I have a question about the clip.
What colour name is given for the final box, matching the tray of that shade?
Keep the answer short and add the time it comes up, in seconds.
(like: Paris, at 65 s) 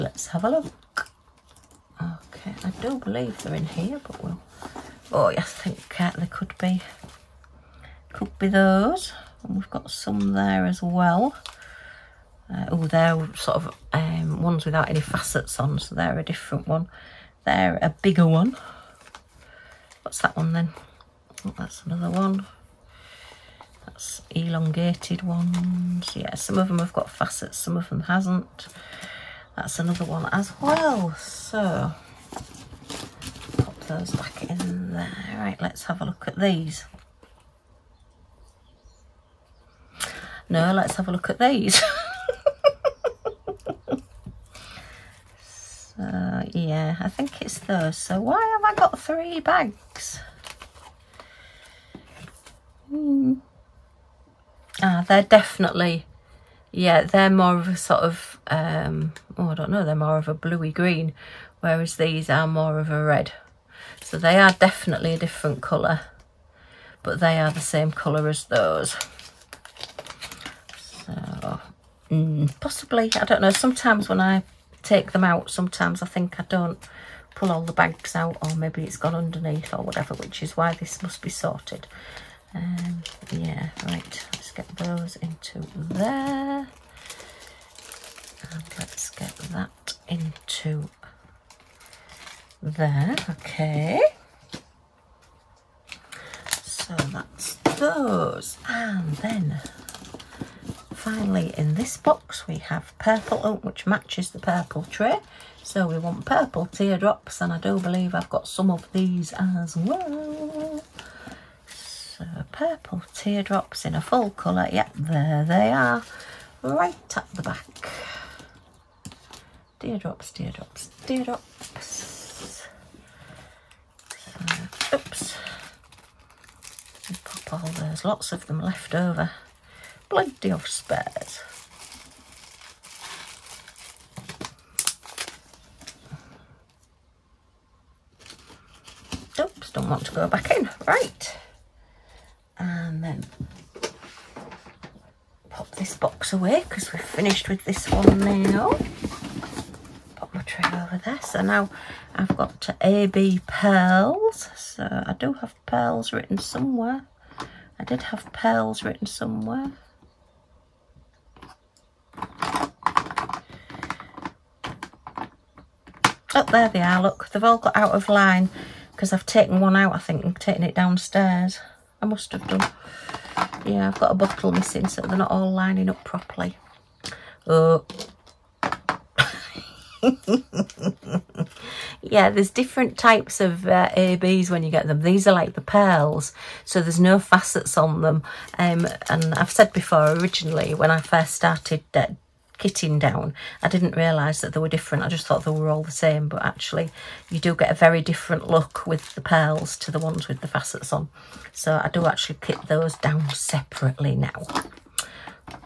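purple oak, at 102 s.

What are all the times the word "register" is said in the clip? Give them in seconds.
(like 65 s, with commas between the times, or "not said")
not said.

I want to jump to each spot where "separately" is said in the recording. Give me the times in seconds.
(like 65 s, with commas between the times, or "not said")
203 s.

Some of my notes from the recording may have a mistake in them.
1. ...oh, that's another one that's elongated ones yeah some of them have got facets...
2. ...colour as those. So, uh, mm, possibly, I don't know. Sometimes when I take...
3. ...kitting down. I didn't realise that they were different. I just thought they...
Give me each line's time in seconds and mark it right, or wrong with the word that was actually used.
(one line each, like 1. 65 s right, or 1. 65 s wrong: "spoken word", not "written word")
1. 21 s right
2. 67 s right
3. 192 s right.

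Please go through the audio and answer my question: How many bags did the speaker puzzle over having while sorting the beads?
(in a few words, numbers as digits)
3.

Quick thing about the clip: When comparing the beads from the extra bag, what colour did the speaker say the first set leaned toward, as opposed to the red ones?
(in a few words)
bluey green.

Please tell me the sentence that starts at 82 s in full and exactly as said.
Um, yeah, right, let's get those into there.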